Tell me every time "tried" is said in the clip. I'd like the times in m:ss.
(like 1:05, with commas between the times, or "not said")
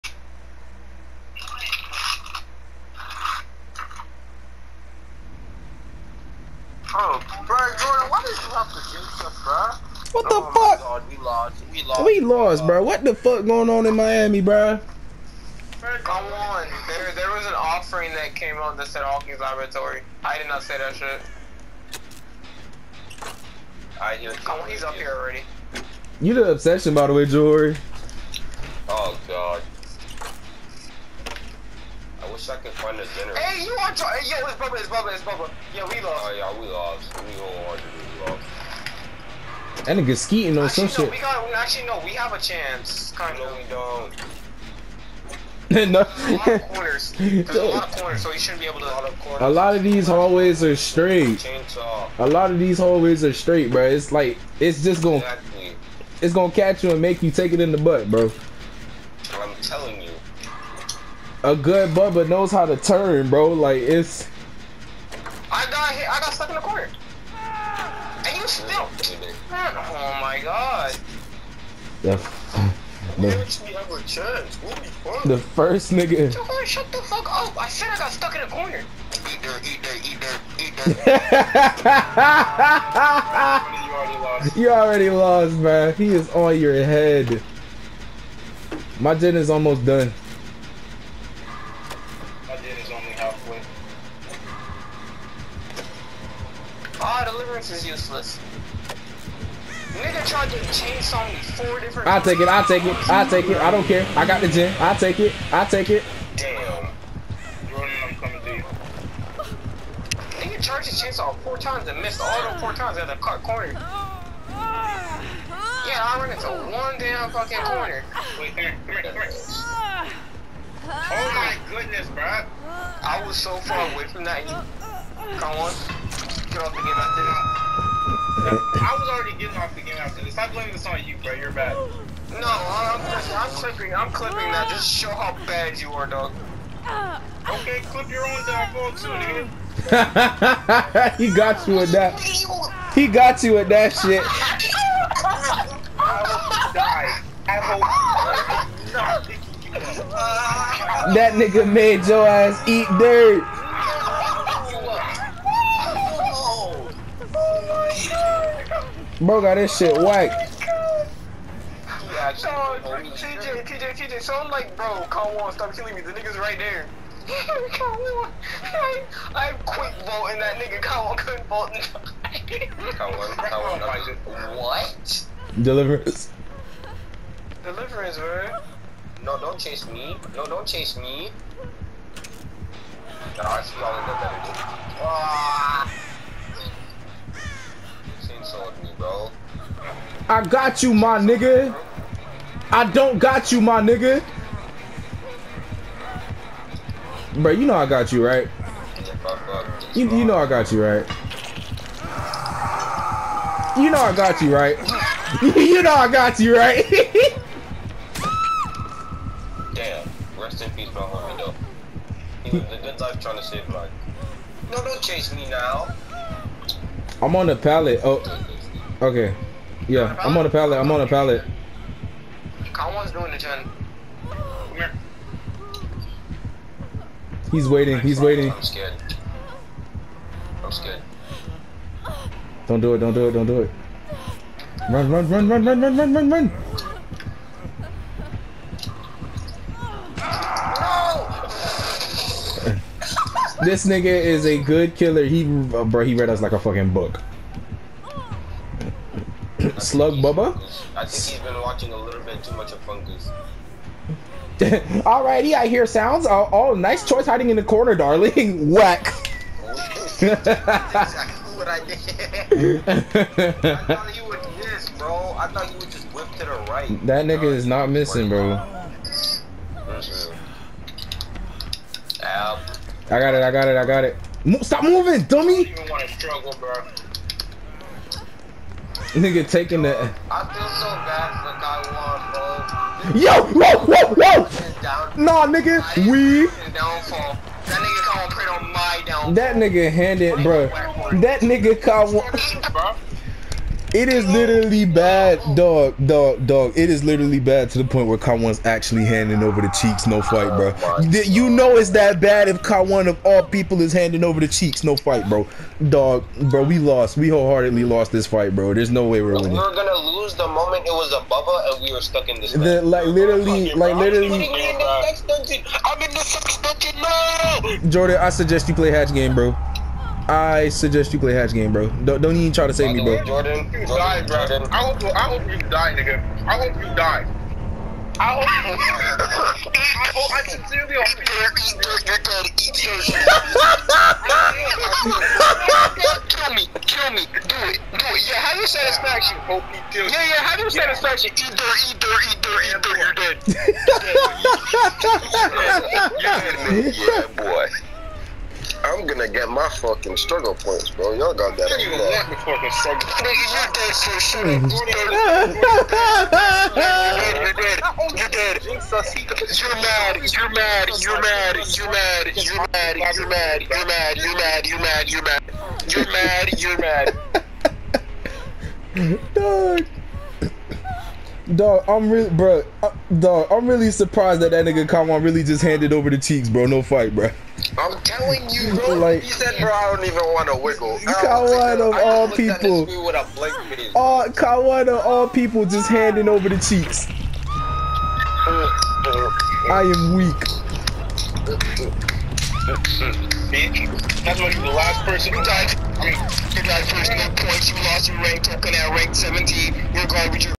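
1:40.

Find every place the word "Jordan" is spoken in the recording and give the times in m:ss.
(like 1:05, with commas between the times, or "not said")
1:47, 5:17, 5:23.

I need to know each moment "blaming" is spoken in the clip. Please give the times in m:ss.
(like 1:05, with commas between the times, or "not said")
2:10.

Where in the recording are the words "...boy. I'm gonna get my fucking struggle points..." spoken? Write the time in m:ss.
5:47.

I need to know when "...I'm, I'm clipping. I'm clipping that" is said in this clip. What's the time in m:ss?
2:12.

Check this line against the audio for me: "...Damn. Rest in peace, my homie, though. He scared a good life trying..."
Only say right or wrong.
wrong.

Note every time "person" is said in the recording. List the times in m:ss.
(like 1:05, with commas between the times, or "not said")
6:35.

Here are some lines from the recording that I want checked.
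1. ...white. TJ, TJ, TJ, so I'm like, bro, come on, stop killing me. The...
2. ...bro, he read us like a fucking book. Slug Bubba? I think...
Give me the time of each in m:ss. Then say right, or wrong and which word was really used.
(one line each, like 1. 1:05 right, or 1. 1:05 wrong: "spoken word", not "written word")
1. 2:40 right
2. 4:05 right.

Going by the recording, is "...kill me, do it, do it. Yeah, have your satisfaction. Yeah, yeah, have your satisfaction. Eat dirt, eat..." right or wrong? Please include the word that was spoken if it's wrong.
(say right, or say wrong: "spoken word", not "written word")
right.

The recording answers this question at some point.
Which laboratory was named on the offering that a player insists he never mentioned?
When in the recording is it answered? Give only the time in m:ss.
0:19.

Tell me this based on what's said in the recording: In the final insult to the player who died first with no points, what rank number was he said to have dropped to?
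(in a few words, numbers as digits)
17.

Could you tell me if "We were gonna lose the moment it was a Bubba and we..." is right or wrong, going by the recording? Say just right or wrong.
right.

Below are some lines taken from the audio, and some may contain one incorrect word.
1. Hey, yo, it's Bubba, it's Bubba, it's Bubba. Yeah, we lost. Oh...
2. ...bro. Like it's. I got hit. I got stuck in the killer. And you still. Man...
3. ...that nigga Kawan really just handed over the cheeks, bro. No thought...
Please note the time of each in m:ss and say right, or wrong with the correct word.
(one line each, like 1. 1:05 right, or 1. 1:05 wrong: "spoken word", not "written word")
1. 0:34 right
2. 1:03 wrong: "corner", not "killer"
3. 6:14 wrong: "fight", not "thought".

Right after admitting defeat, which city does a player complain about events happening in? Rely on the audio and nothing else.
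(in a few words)
Miami.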